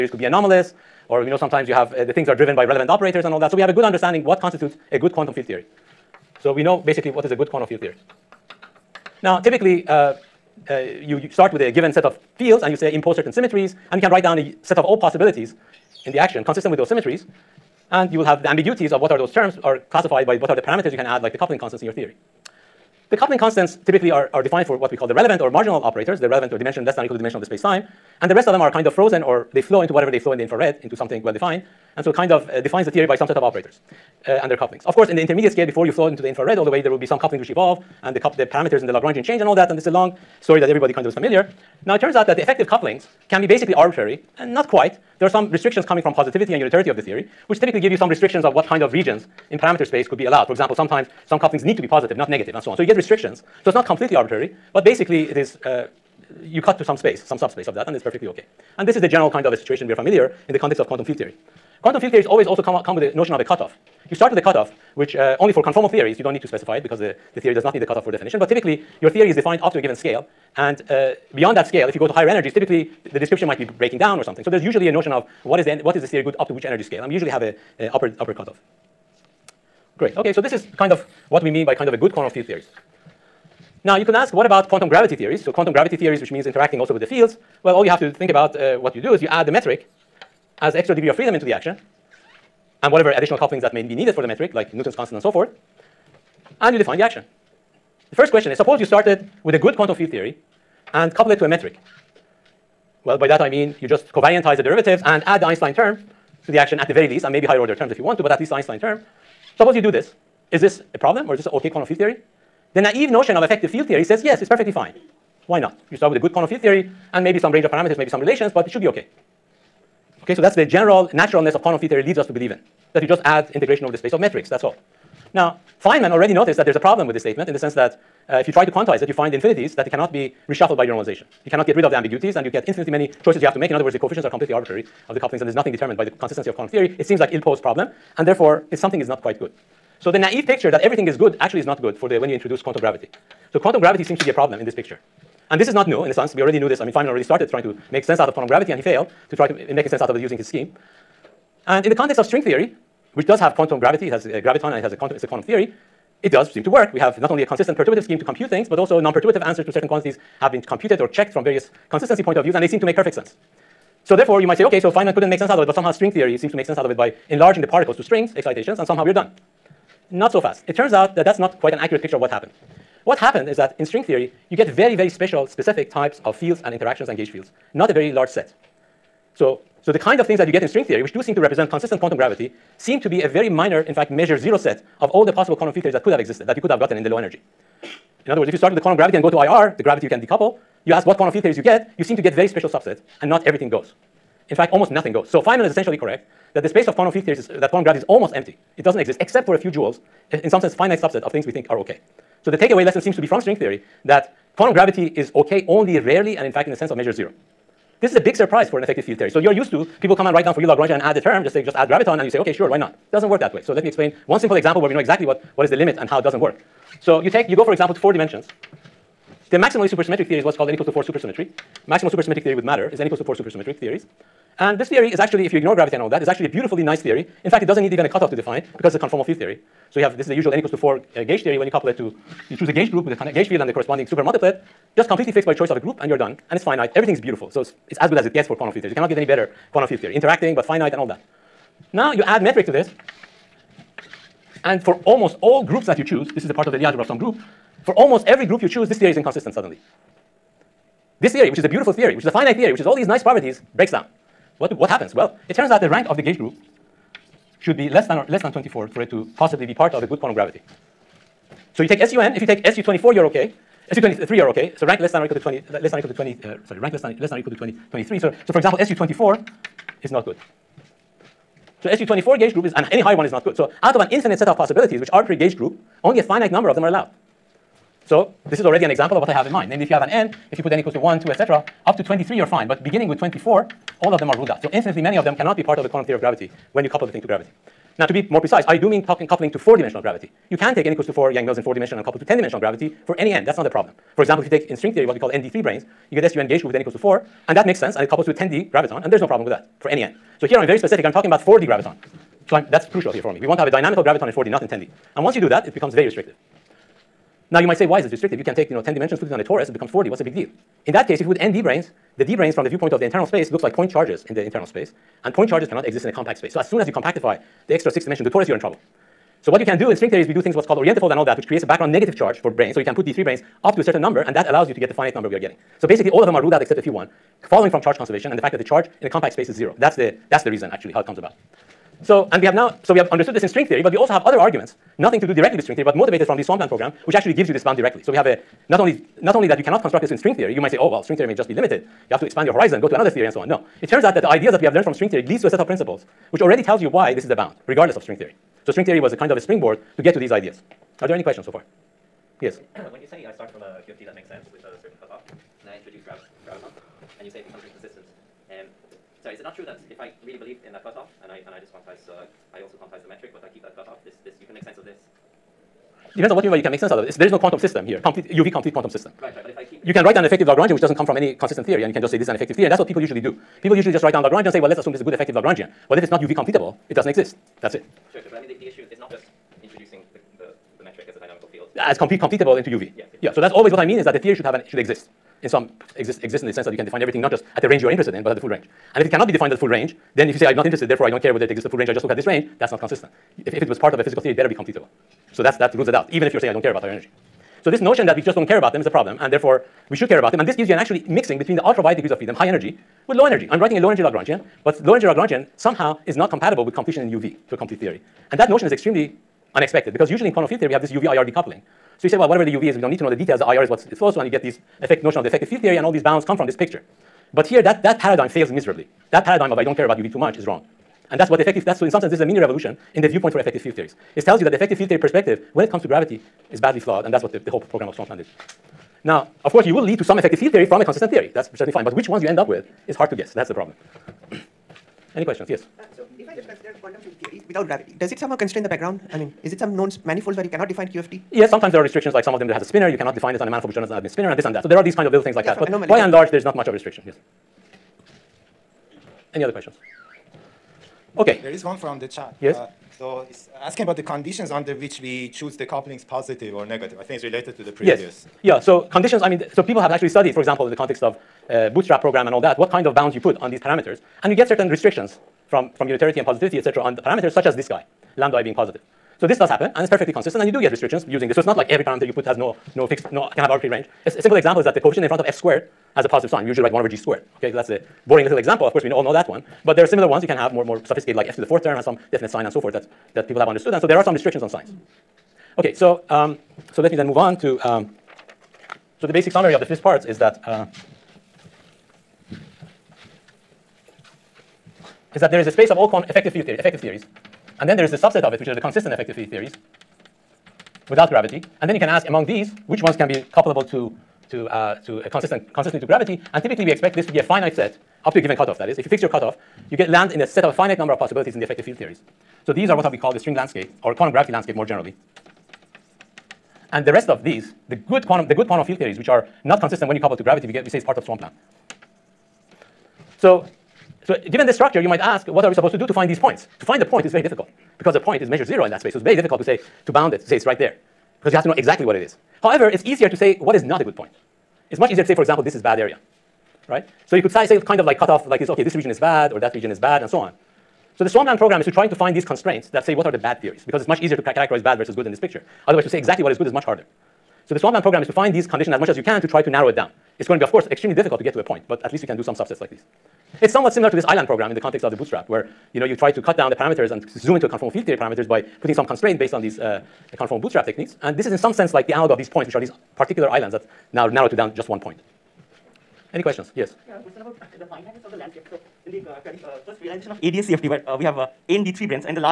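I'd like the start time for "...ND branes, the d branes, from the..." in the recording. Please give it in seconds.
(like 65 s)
311 s.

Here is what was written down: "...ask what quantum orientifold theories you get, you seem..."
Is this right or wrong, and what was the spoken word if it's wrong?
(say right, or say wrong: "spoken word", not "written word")
wrong: "field", not "orientifold".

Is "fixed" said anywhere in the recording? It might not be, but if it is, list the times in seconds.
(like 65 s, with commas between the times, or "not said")
235 s, 472 s.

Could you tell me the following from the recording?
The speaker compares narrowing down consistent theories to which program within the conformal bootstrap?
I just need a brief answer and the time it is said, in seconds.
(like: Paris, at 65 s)
island program, at 554 s.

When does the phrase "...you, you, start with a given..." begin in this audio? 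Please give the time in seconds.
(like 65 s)
10 s.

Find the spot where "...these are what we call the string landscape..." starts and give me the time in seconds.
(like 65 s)
512 s.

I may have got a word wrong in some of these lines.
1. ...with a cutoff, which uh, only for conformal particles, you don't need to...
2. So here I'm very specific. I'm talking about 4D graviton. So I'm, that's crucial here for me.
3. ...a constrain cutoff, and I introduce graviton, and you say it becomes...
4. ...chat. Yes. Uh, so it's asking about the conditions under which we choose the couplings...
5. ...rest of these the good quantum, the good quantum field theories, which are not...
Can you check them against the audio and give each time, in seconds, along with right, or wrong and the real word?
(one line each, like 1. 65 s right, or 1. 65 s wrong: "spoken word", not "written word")
1. 64 s wrong: "theories", not "particles"
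2. 300 s right
3. 354 s wrong: "certain", not "constrain"
4. 452 s right
5. 516 s right.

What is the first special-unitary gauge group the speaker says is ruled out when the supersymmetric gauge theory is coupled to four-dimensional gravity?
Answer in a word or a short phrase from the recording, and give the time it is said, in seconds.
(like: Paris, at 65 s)
SU24, at 268 s.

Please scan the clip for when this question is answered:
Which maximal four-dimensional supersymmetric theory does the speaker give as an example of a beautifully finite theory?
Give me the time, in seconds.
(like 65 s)
220 s.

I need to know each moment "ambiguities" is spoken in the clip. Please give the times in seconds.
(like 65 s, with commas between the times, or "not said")
18 s, 131 s.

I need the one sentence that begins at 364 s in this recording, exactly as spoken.
This this you can make sense of this.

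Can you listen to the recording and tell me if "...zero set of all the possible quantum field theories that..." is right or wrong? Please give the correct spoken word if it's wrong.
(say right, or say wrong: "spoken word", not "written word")
right.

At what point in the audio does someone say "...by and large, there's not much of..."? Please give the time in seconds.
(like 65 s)
445 s.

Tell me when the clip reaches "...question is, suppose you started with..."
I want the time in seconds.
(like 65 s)
98 s.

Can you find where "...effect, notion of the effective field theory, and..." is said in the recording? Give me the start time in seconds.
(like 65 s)
414 s.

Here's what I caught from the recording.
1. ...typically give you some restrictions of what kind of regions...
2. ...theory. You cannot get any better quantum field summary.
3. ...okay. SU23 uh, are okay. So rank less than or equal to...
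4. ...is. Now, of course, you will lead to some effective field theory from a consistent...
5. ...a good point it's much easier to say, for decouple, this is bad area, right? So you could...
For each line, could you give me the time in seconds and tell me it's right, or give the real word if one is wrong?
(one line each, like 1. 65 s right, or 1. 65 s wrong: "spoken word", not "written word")
1. 47 s right
2. 238 s wrong: "theory", not "summary"
3. 263 s right
4. 428 s right
5. 533 s wrong: "example", not "decouple".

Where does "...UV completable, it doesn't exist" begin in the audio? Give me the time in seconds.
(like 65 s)
376 s.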